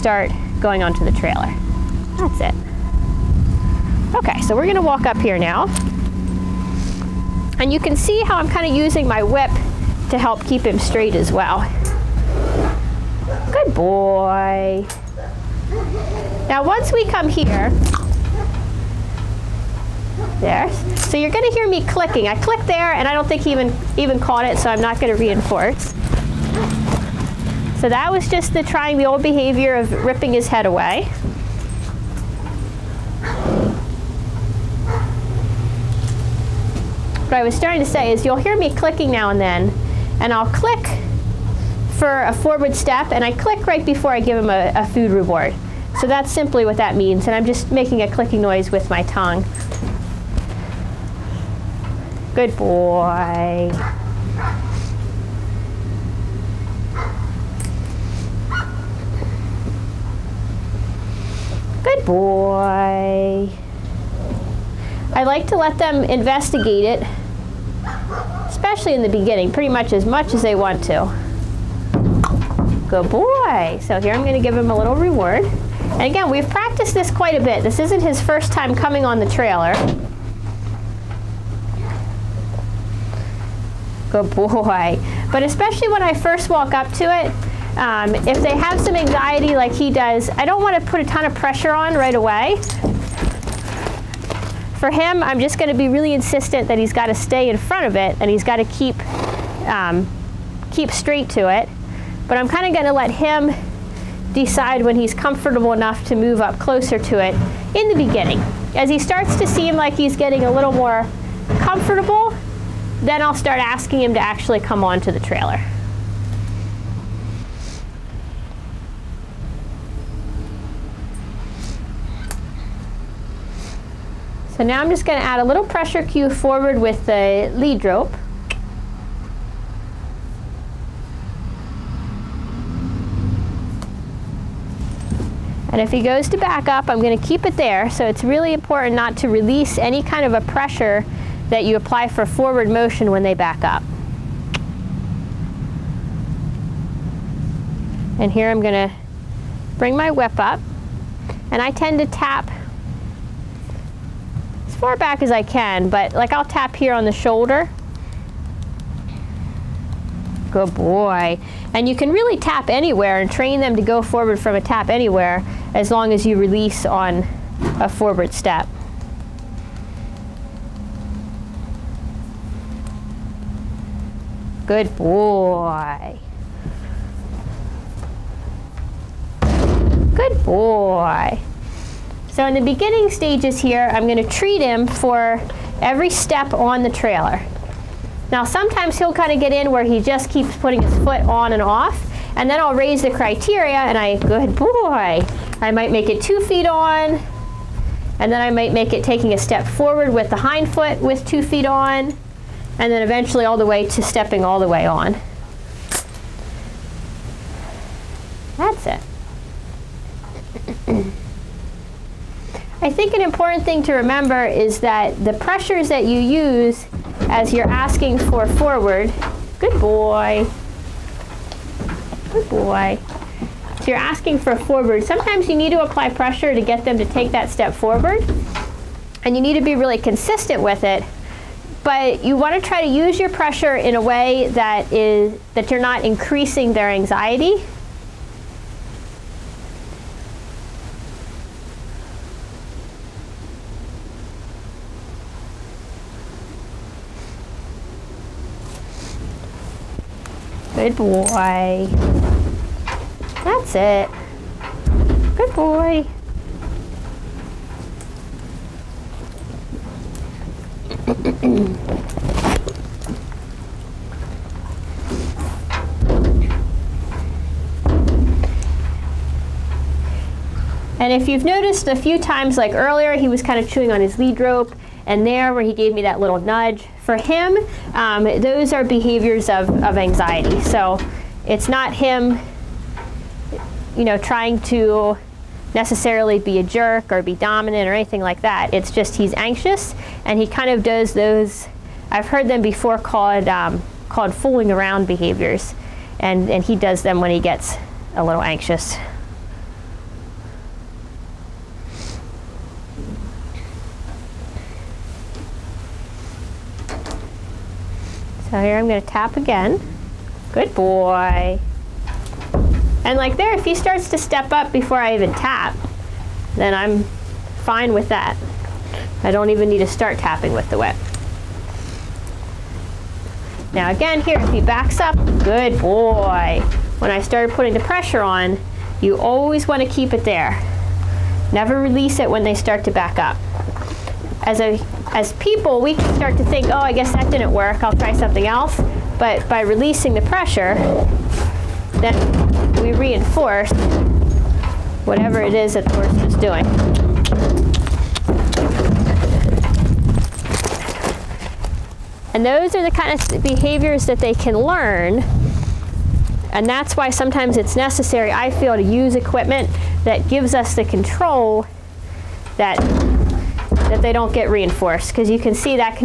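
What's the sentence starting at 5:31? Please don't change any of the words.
Never release it when they start to back up.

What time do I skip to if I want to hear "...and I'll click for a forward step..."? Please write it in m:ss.
0:40.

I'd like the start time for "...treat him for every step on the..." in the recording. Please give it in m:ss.
3:04.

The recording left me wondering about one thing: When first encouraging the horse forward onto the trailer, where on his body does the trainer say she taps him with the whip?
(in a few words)
Shoulder.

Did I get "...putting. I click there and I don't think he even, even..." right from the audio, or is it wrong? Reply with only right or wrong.
wrong.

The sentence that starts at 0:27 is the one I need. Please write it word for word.
So that was just the trying the old behavior of ripping his head away.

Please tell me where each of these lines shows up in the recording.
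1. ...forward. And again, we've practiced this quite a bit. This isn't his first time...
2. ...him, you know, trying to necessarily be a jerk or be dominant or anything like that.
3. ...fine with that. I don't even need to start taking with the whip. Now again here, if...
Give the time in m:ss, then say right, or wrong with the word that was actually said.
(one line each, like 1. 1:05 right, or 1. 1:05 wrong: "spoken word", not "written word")
1. 1:14 wrong: "reward", not "forward"
2. 4:41 right
3. 5:17 wrong: "tapping", not "taking".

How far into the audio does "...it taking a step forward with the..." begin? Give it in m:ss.
3:18.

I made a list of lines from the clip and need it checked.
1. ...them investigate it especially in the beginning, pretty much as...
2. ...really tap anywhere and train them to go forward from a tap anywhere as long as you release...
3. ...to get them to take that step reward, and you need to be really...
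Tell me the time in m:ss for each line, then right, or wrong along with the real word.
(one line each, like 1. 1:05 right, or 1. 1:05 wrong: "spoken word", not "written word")
1. 1:05 right
2. 2:42 right
3. 3:46 wrong: "forward", not "reward".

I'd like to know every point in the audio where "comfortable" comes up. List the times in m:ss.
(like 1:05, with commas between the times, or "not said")
1:45, 1:51.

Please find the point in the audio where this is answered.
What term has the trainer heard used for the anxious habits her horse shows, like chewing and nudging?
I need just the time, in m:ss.
4:54.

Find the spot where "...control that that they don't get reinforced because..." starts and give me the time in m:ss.
6:00.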